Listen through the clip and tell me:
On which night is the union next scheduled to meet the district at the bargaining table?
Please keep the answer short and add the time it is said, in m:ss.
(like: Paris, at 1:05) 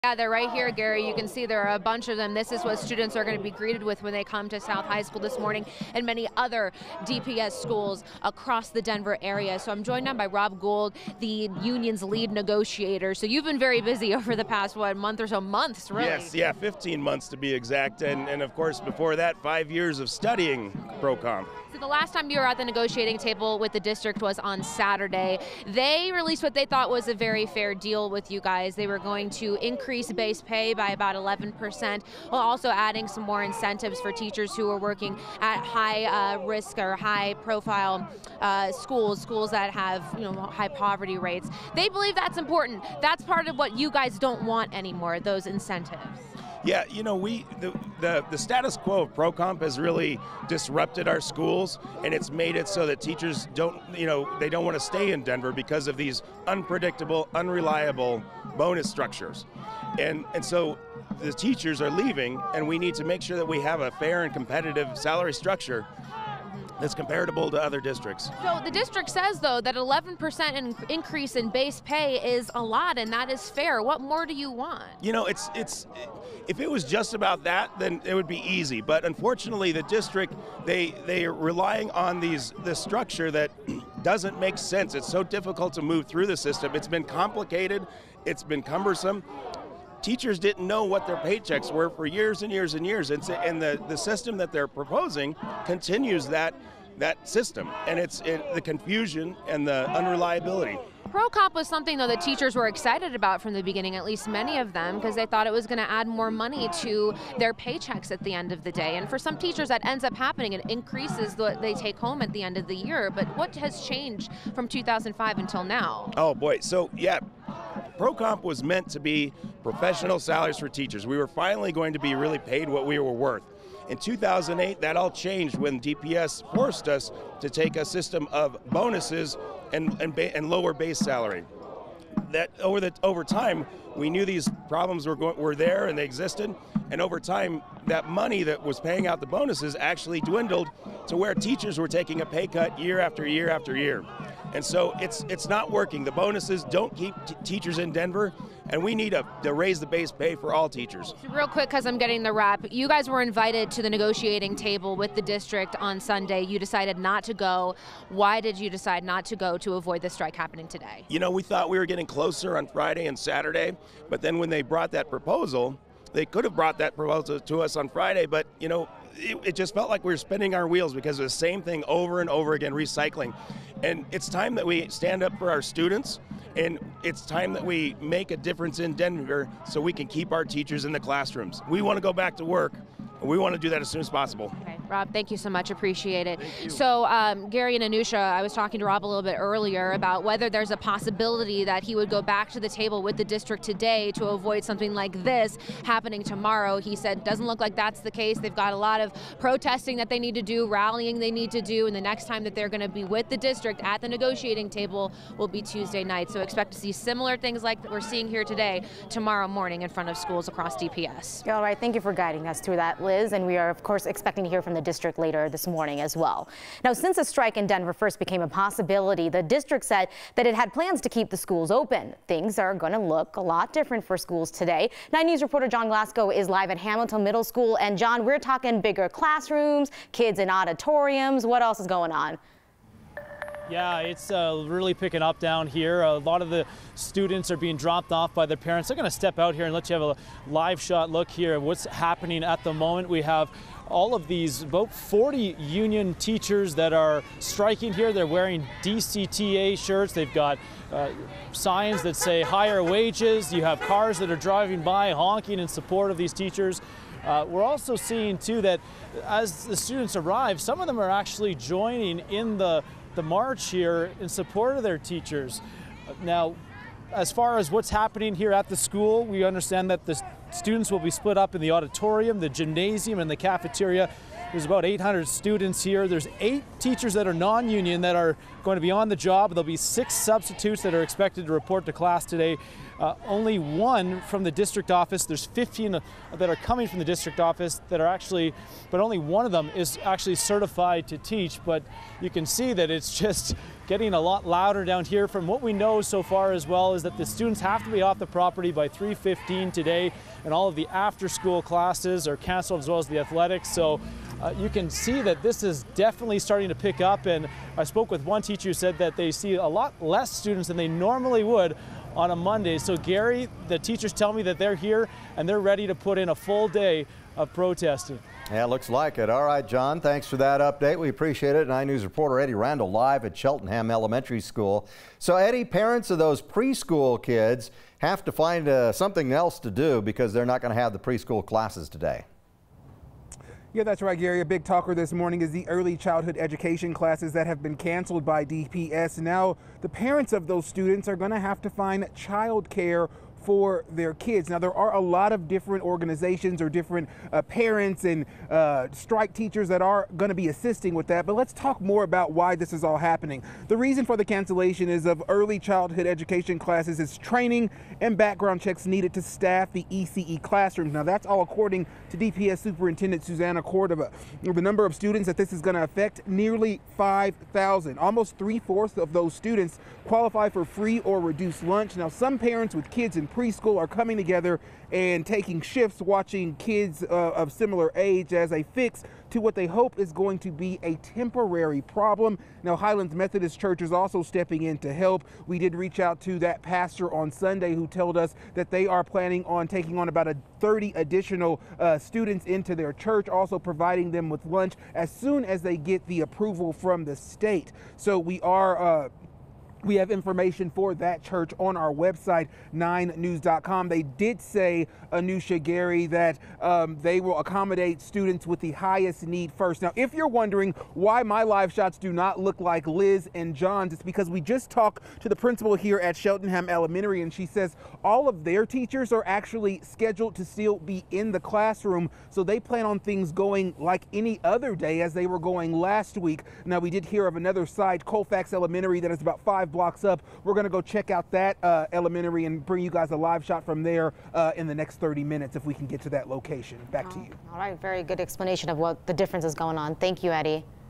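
Tuesday night, at 3:25.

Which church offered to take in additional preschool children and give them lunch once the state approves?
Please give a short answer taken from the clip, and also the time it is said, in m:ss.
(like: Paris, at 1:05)
Highlands Methodist Church, at 6:22.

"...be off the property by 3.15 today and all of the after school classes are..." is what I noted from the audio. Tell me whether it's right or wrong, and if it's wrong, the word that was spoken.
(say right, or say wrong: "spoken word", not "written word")
right.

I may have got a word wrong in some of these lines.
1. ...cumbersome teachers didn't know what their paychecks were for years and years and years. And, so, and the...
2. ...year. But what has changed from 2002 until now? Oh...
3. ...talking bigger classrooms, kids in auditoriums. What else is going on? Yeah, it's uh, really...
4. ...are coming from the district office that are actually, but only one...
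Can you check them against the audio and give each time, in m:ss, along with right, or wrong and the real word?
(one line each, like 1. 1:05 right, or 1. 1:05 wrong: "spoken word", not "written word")
1. 1:28 right
2. 1:52 wrong: "2005", not "2002"
3. 3:48 right
4. 4:46 right.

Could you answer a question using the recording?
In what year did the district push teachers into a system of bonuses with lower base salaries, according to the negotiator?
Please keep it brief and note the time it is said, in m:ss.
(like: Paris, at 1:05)
2008, at 2:03.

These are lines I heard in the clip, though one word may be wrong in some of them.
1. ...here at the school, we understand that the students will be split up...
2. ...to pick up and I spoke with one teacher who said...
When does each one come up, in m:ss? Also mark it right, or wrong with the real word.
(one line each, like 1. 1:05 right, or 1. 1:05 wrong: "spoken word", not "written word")
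1. 4:28 right
2. 5:06 right.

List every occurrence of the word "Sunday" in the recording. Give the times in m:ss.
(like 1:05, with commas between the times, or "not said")
2:35, 6:27.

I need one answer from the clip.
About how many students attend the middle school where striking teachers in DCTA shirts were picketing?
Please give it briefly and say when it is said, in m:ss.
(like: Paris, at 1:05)
800, at 4:34.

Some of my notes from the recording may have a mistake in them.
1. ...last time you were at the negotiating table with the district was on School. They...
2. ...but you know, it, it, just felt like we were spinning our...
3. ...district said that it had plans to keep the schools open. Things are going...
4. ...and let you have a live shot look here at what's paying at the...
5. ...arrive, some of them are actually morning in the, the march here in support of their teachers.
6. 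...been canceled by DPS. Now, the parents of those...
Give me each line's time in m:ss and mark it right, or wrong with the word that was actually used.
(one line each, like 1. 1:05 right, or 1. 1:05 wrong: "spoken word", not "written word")
1. 0:21 wrong: "Saturday", not "School"
2. 2:48 right
3. 3:39 right
4. 3:59 wrong: "happening", not "paying"
5. 4:20 wrong: "joining", not "morning"
6. 5:37 right.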